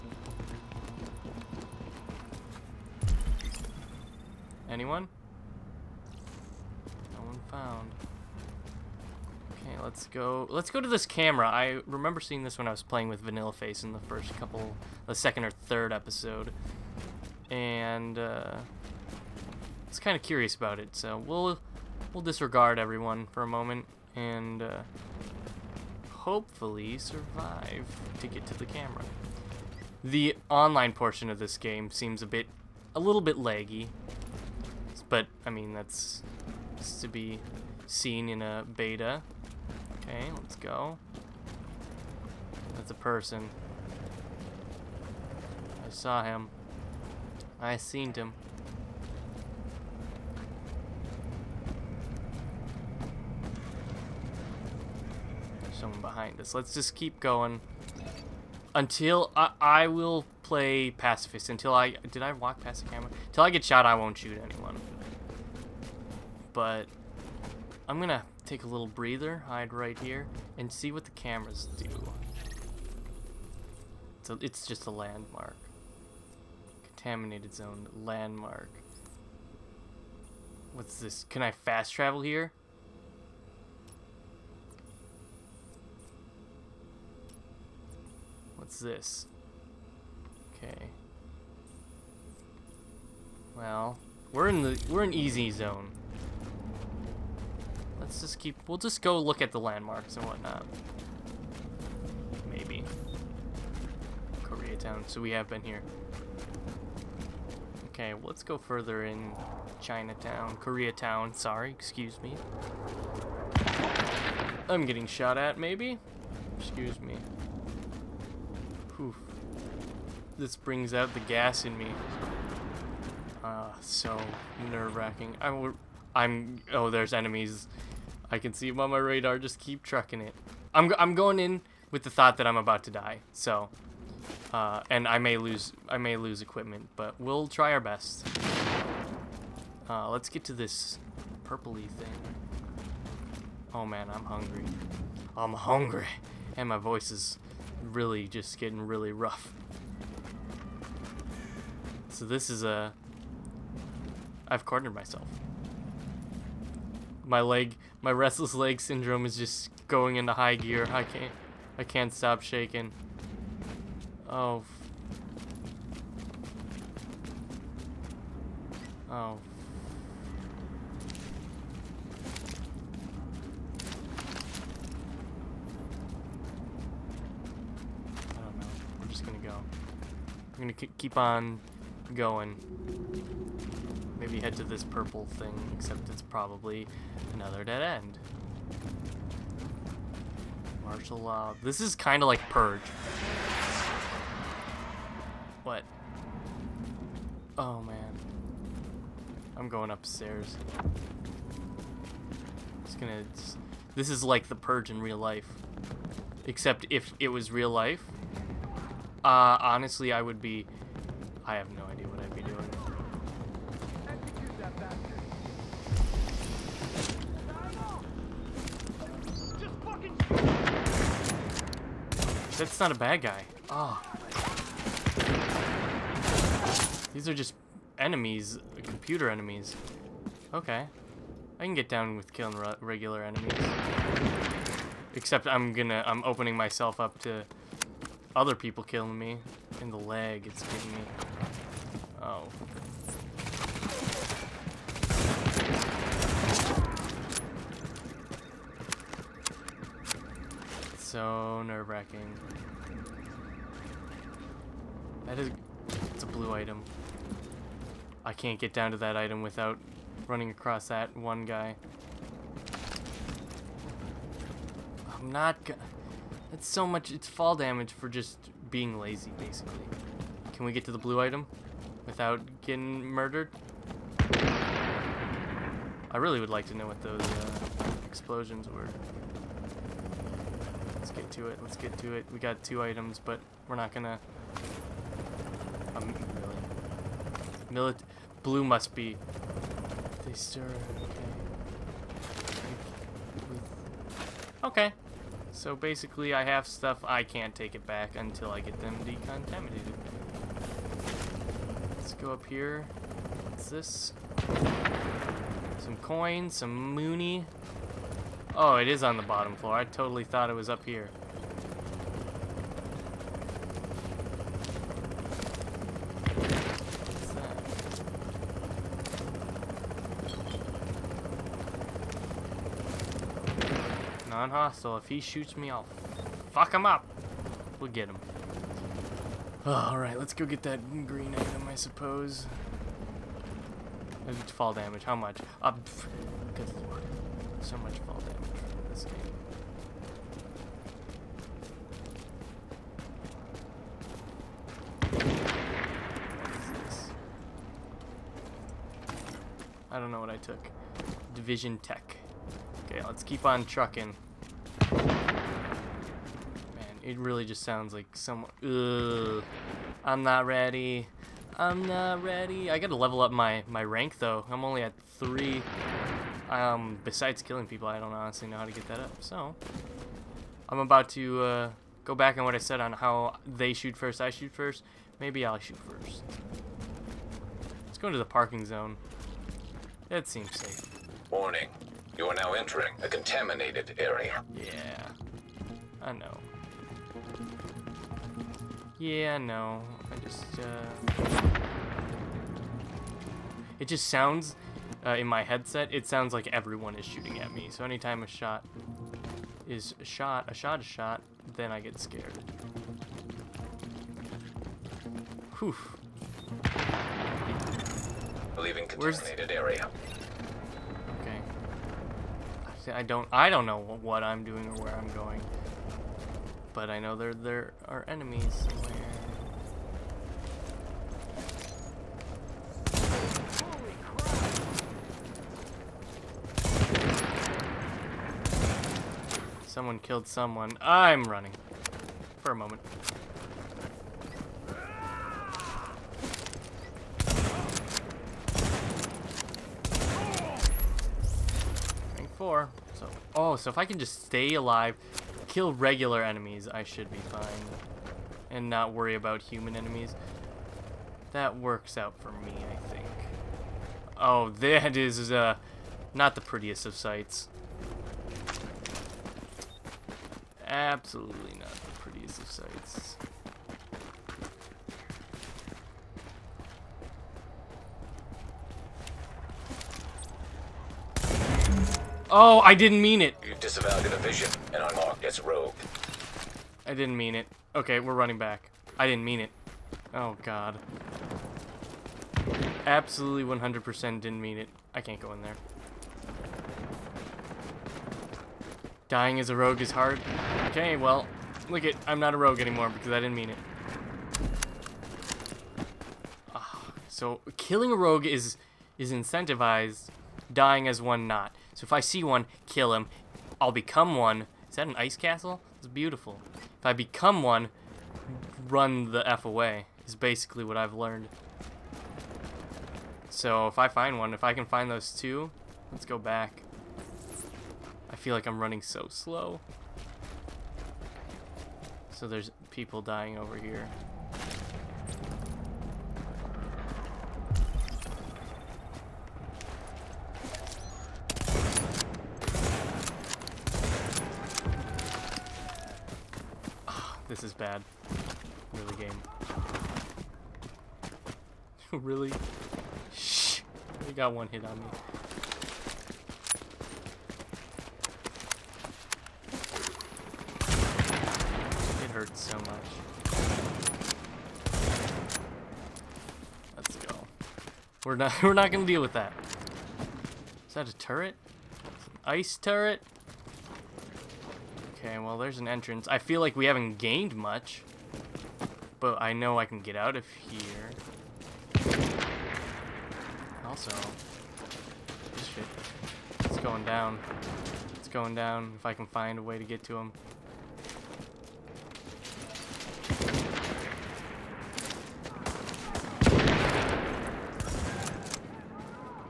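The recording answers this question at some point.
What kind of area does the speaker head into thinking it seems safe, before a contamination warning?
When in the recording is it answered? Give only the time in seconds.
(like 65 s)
378 s.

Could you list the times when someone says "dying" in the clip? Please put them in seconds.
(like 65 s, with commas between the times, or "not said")
489 s, 500 s, 522 s.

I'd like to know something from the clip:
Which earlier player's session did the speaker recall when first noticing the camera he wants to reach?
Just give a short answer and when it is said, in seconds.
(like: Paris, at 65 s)
Vanilla Face, at 13 s.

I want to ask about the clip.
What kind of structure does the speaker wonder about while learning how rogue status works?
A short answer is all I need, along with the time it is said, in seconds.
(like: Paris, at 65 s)
ice castle, at 504 s.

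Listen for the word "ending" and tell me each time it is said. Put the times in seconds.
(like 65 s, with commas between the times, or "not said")
not said.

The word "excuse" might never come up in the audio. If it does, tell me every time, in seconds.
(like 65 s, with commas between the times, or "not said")
111 s, 116 s.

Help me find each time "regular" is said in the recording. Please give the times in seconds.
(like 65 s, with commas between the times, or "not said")
232 s, 445 s.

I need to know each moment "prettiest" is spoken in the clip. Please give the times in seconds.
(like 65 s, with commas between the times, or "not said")
456 s, 461 s.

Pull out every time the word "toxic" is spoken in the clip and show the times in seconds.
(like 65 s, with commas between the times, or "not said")
not said.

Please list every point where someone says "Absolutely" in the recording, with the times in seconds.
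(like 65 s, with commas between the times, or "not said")
460 s, 482 s.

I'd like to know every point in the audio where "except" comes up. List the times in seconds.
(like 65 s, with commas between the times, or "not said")
185 s, 206 s, 235 s.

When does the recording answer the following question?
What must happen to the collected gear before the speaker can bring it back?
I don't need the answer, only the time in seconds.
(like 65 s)
299 s.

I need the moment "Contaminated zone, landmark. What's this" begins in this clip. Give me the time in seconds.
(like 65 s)
76 s.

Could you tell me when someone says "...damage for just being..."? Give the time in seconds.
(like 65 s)
267 s.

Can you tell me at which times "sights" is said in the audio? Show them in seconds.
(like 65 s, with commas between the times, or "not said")
456 s, 462 s.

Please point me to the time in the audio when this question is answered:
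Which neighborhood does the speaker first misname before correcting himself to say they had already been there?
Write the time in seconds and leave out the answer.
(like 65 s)
109 s.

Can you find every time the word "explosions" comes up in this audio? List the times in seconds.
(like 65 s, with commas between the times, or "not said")
278 s.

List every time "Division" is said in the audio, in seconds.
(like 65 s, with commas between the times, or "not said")
351 s.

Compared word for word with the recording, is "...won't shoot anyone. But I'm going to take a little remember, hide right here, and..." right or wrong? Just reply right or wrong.
wrong.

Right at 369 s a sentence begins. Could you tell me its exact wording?
So, I'm about to uh, go back on what I said on how they shoot first, I shoot first.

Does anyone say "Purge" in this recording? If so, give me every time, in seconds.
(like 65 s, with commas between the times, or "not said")
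192 s, 204 s.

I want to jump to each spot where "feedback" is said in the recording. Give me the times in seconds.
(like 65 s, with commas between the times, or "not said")
not said.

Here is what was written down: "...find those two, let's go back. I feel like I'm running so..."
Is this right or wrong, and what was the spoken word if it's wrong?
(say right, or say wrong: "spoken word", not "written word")
right.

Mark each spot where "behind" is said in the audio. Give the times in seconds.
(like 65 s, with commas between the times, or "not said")
56 s.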